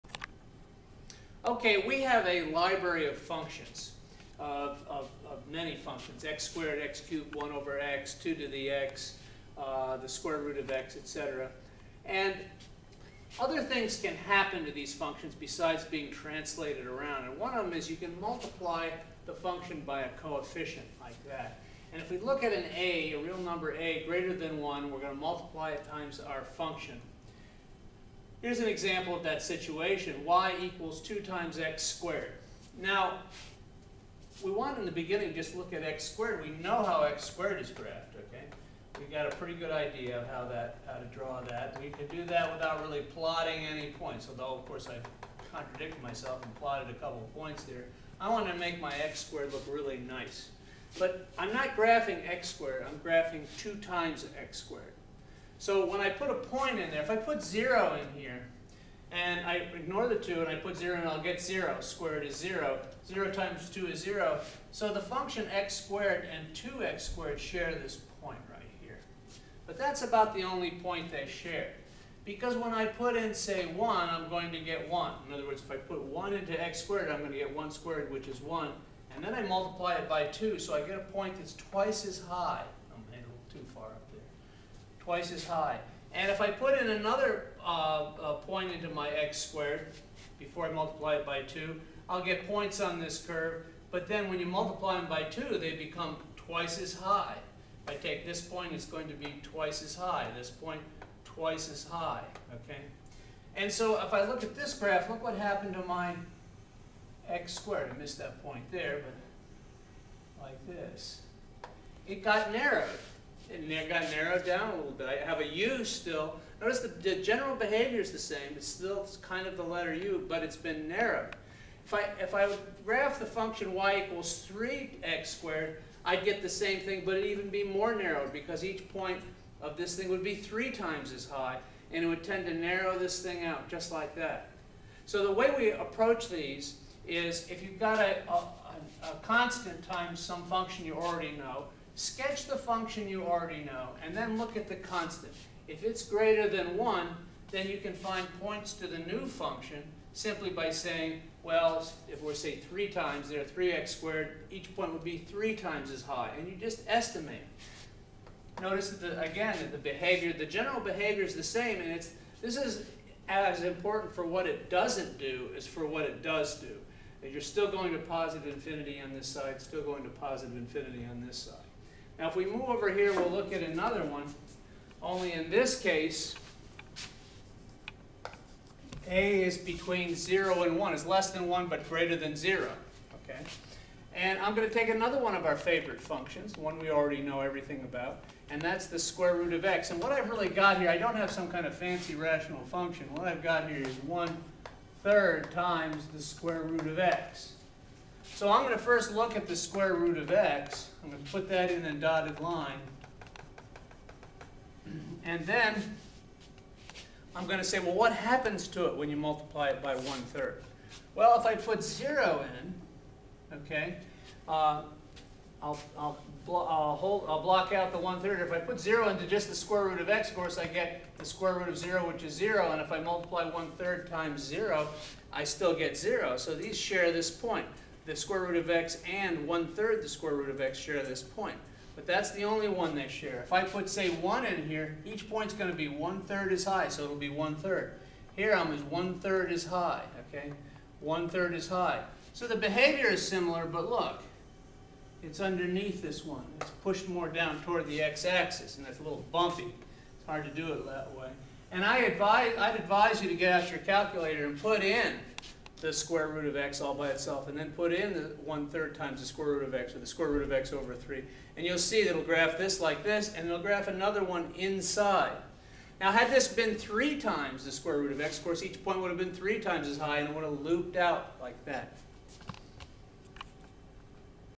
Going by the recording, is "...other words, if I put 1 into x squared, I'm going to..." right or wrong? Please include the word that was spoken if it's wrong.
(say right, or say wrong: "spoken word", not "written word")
right.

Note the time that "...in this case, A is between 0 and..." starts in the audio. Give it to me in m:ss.
2:55.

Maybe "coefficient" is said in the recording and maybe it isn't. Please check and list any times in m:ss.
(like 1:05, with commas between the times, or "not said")
0:20.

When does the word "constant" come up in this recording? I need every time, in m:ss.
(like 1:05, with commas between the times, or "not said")
2:19, 2:24.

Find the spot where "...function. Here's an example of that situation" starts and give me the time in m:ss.
0:26.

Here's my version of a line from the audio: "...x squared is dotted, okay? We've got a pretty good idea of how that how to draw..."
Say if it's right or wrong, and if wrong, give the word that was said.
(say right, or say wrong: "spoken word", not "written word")
wrong: "graphed", not "dotted".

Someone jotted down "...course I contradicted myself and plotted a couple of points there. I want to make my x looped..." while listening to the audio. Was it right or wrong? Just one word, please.
wrong.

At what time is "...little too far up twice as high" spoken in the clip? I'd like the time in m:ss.
1:23.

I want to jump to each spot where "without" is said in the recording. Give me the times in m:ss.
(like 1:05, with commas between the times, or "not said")
0:42.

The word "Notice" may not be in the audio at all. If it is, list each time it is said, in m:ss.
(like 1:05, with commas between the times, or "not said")
1:56, 2:38.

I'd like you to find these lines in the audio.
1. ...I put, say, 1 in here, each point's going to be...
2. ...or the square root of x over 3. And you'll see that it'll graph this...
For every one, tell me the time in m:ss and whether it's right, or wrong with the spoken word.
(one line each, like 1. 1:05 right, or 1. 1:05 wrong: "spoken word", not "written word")
1. 3:53 right
2. 4:19 right.